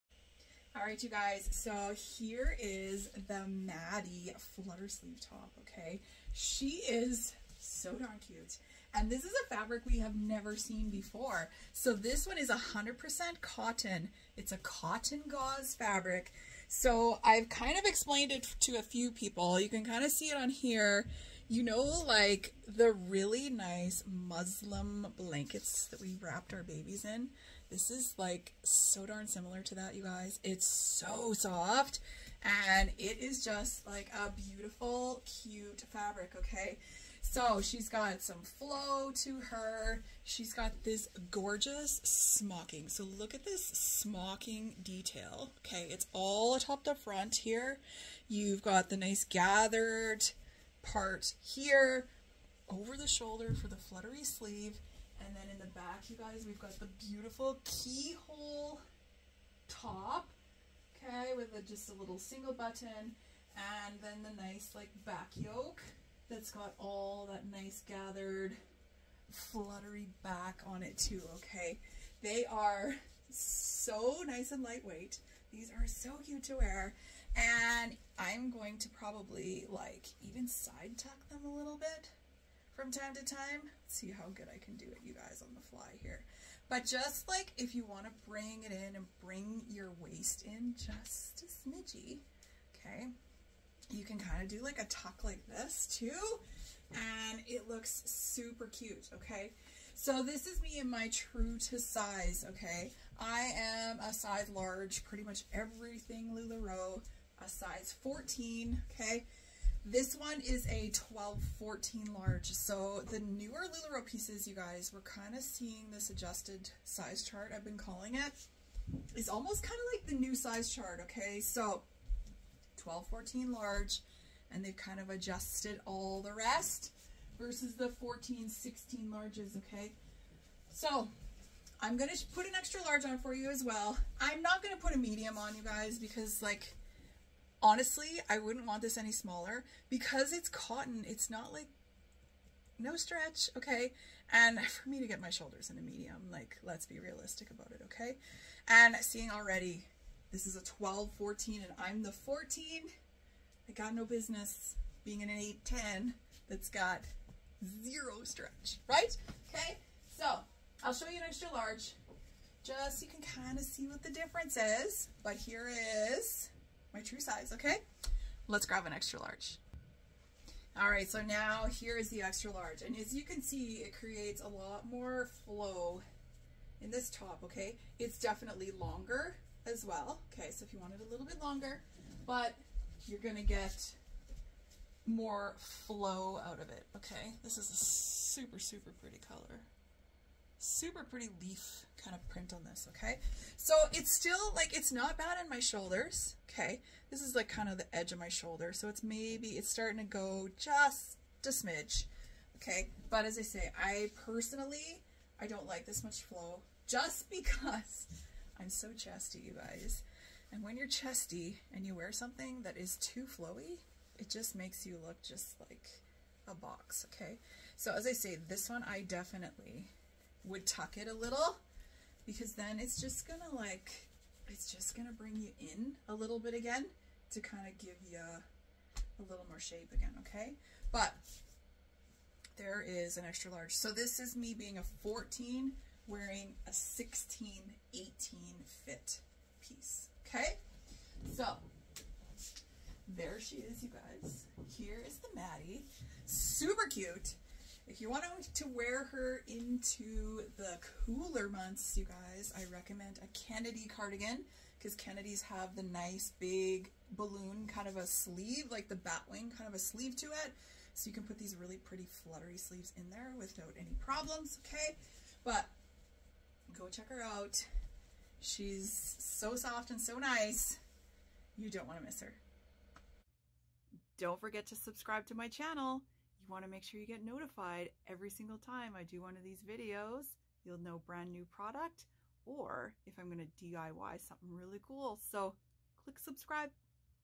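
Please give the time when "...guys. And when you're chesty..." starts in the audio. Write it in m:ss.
3:29.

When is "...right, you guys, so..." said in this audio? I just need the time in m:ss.
0:00.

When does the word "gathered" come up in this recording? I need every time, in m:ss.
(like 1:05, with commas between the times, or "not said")
0:49, 1:07.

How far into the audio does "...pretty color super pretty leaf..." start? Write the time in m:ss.
3:09.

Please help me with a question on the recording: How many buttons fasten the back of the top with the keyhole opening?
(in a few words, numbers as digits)
single button.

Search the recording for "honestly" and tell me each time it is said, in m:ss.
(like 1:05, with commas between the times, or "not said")
2:17.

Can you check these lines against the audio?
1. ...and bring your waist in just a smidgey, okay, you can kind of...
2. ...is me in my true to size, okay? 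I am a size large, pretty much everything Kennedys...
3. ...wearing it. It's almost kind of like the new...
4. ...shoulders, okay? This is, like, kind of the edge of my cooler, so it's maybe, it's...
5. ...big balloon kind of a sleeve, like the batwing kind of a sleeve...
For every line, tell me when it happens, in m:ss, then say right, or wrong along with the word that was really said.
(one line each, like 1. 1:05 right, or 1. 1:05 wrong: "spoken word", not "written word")
1. 1:28 right
2. 1:40 wrong: "LuLaRoe", not "Kennedys"
3. 1:57 wrong: "calling", not "wearing"
4. 3:15 wrong: "shoulder", not "cooler"
5. 4:16 right.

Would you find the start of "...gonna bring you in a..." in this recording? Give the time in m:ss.
3:44.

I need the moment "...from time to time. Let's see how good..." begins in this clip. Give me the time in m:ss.
1:22.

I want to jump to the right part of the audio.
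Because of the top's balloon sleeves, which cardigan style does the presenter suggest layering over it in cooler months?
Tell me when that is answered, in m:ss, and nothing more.
4:13.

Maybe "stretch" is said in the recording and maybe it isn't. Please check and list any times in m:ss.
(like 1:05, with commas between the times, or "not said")
2:22, 2:38.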